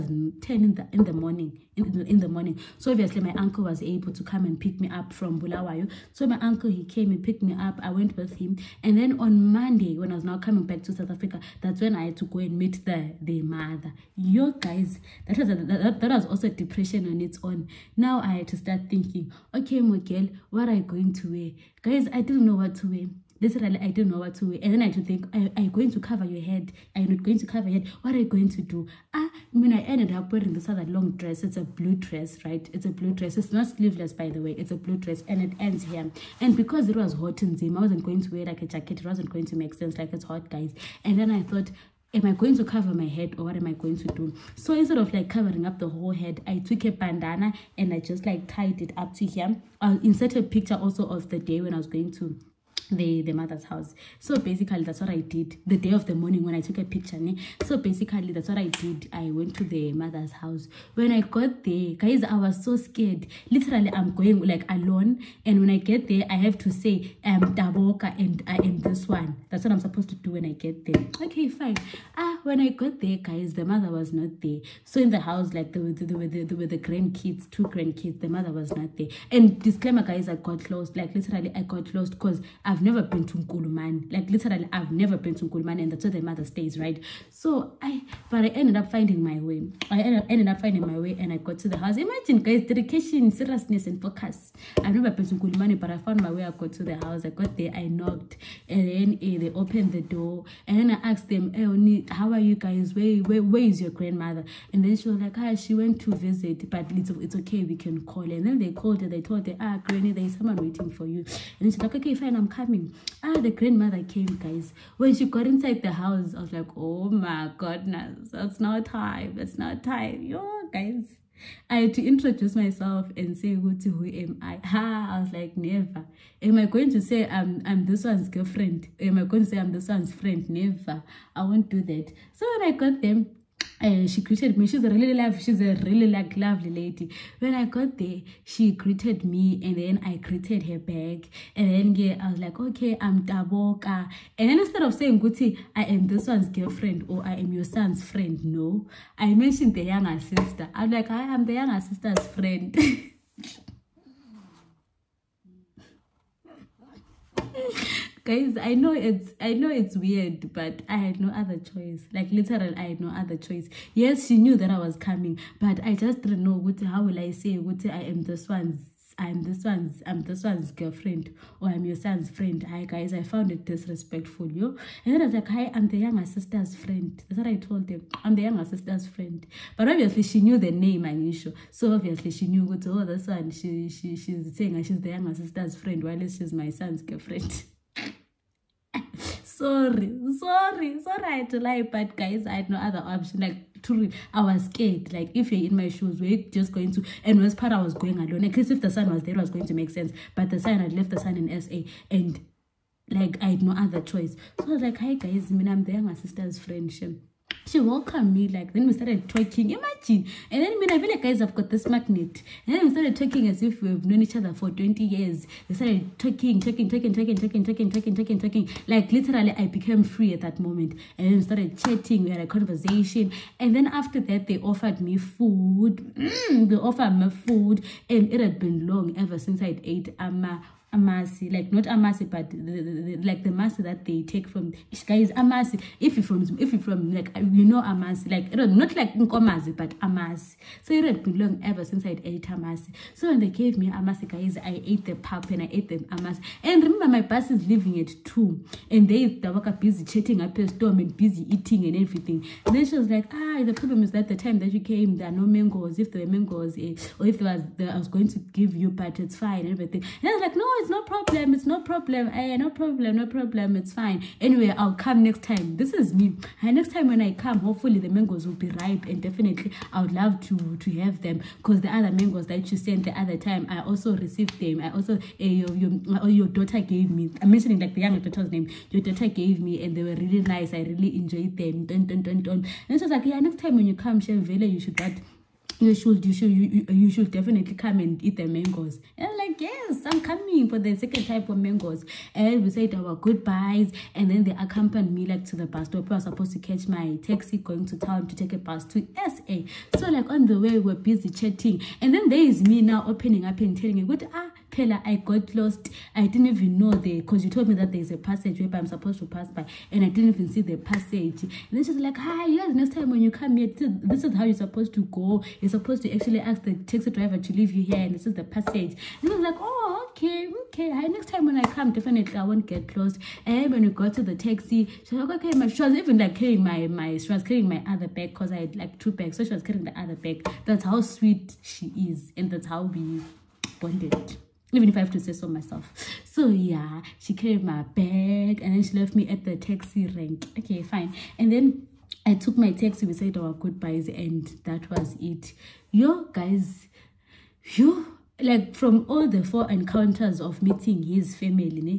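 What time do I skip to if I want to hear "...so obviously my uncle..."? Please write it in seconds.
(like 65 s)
2 s.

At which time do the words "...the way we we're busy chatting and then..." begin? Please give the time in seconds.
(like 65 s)
300 s.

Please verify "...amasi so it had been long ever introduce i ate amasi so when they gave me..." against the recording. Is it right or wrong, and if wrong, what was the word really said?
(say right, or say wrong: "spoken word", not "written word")
wrong: "since", not "introduce".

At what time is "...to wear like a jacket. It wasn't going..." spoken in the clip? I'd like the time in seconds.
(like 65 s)
38 s.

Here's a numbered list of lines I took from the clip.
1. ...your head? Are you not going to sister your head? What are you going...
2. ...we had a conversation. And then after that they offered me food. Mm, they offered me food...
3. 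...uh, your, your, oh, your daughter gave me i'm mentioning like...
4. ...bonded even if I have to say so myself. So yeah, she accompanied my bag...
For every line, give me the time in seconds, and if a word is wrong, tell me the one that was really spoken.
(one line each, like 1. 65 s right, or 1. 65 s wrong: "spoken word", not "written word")
1. 26 s wrong: "cover", not "sister"
2. 222 s right
3. 275 s right
4. 333 s wrong: "carried", not "accompanied".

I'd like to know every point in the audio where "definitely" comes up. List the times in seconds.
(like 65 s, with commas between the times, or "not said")
269 s, 287 s, 321 s.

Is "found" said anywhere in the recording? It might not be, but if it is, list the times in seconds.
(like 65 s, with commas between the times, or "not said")
95 s, 173 s.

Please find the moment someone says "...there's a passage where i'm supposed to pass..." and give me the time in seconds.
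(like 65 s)
307 s.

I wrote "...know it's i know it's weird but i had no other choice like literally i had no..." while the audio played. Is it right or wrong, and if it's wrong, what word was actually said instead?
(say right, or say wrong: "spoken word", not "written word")
right.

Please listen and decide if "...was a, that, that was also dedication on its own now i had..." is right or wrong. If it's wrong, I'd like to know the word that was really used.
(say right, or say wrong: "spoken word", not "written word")
wrong: "depression", not "dedication".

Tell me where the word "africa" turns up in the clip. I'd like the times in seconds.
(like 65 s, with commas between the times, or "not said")
11 s.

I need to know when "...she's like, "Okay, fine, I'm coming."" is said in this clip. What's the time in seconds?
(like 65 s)
111 s.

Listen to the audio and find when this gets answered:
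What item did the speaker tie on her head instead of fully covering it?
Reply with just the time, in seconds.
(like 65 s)
46 s.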